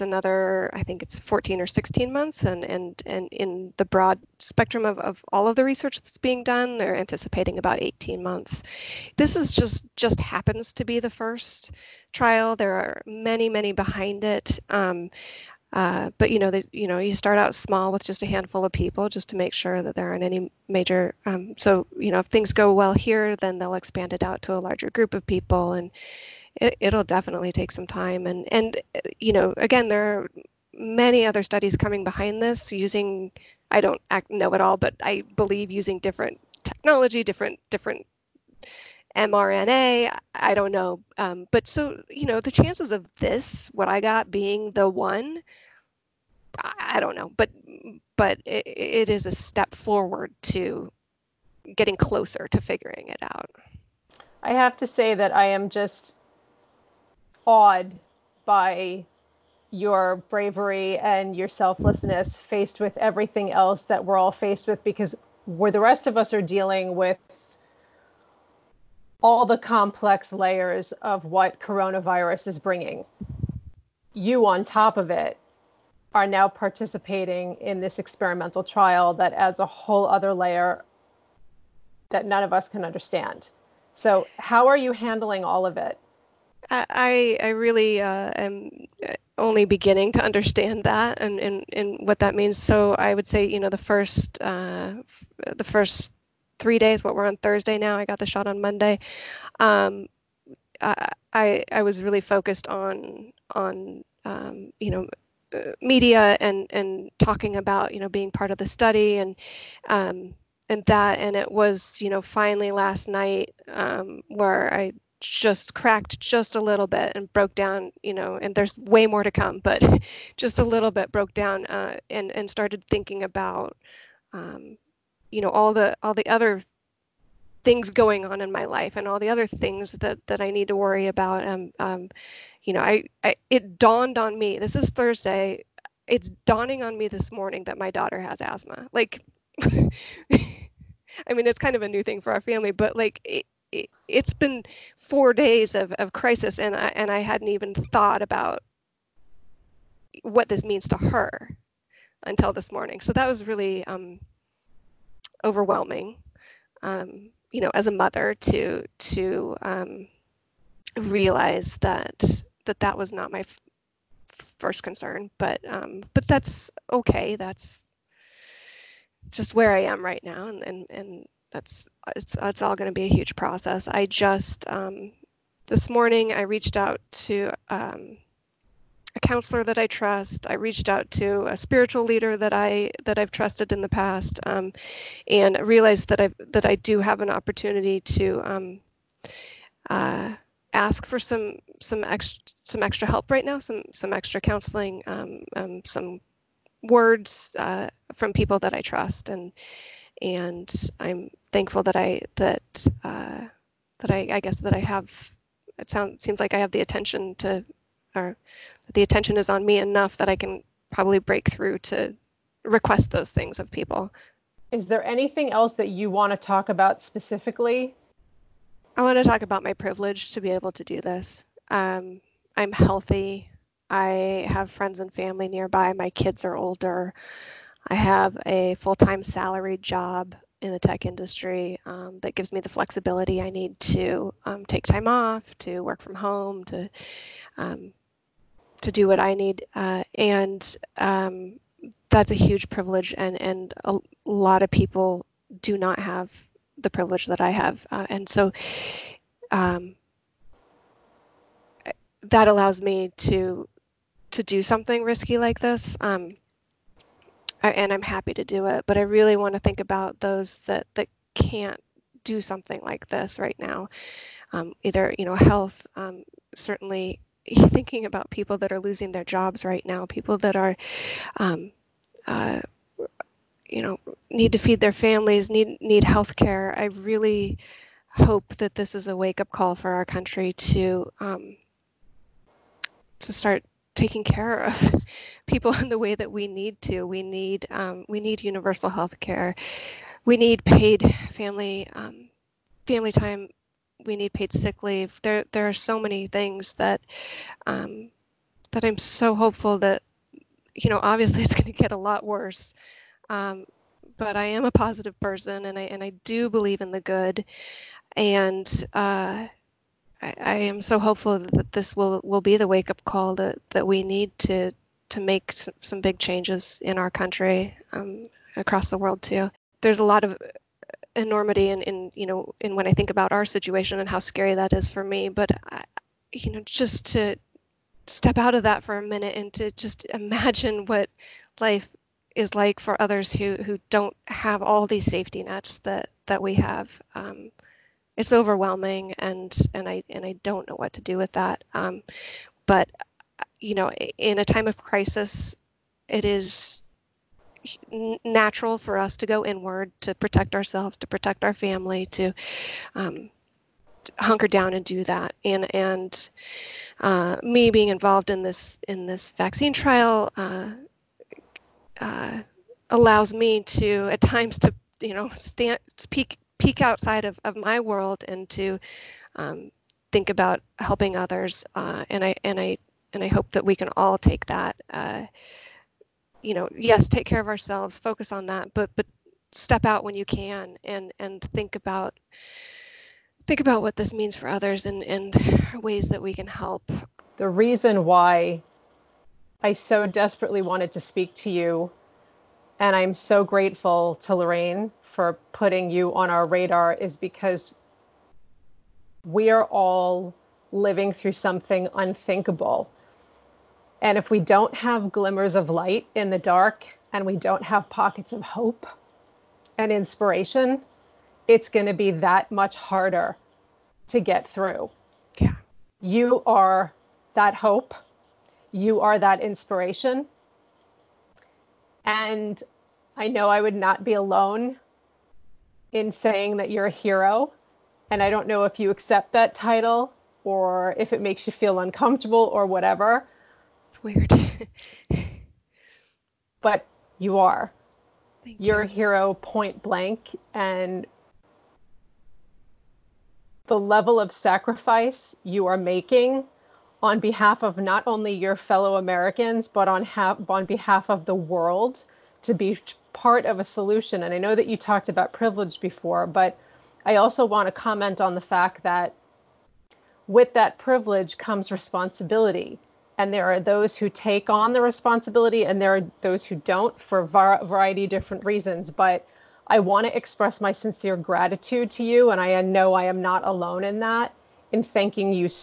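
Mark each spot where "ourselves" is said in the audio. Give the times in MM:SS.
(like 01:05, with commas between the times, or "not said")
05:50, 06:17.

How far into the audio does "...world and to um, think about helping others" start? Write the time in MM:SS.
06:07.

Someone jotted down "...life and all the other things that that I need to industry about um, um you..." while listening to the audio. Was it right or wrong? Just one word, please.
wrong.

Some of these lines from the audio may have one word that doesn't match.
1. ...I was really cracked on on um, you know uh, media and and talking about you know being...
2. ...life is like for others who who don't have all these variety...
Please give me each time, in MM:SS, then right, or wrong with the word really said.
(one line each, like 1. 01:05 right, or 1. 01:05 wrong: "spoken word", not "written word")
1. 01:41 wrong: "focused", not "cracked"
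2. 05:31 wrong: "safety", not "variety".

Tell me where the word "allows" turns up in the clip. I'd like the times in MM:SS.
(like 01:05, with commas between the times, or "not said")
04:12, 06:02.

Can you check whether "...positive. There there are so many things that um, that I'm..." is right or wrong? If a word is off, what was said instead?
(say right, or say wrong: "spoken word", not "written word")
wrong: "leave", not "positive".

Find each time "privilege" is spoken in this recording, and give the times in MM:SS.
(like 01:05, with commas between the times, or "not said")
03:39, 04:02, 04:06, 07:35, 07:40.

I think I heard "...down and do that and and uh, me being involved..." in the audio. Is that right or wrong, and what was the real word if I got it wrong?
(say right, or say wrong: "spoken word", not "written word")
right.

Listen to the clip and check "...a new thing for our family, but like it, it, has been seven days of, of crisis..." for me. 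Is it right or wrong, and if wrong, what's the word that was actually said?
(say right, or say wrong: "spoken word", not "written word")
wrong: "four", not "seven".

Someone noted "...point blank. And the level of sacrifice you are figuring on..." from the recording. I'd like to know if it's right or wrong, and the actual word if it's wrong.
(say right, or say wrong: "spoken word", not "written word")
wrong: "making", not "figuring".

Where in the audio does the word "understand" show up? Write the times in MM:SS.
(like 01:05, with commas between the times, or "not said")
01:22, 01:30.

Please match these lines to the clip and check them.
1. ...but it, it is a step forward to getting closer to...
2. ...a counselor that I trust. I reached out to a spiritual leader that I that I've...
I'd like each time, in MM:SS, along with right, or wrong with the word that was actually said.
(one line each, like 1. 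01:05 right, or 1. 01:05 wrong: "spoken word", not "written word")
1. 00:48 right
2. 02:59 right.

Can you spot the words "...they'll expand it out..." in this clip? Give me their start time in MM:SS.
00:23.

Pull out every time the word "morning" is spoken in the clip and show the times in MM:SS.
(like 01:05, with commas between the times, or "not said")
02:17, 02:32, 02:55.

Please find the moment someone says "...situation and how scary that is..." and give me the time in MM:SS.
05:23.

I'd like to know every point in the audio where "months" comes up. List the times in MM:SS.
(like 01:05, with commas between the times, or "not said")
00:02, 00:08.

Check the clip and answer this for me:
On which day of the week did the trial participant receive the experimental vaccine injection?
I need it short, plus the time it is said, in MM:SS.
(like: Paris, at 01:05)
Monday, at 01:38.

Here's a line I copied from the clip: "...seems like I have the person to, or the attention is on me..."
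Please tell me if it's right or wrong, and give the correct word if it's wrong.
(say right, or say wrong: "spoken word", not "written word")
wrong: "attention", not "person".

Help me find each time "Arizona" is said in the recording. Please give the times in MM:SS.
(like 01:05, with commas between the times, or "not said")
not said.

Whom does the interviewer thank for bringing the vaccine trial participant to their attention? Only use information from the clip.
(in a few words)
Lorraine.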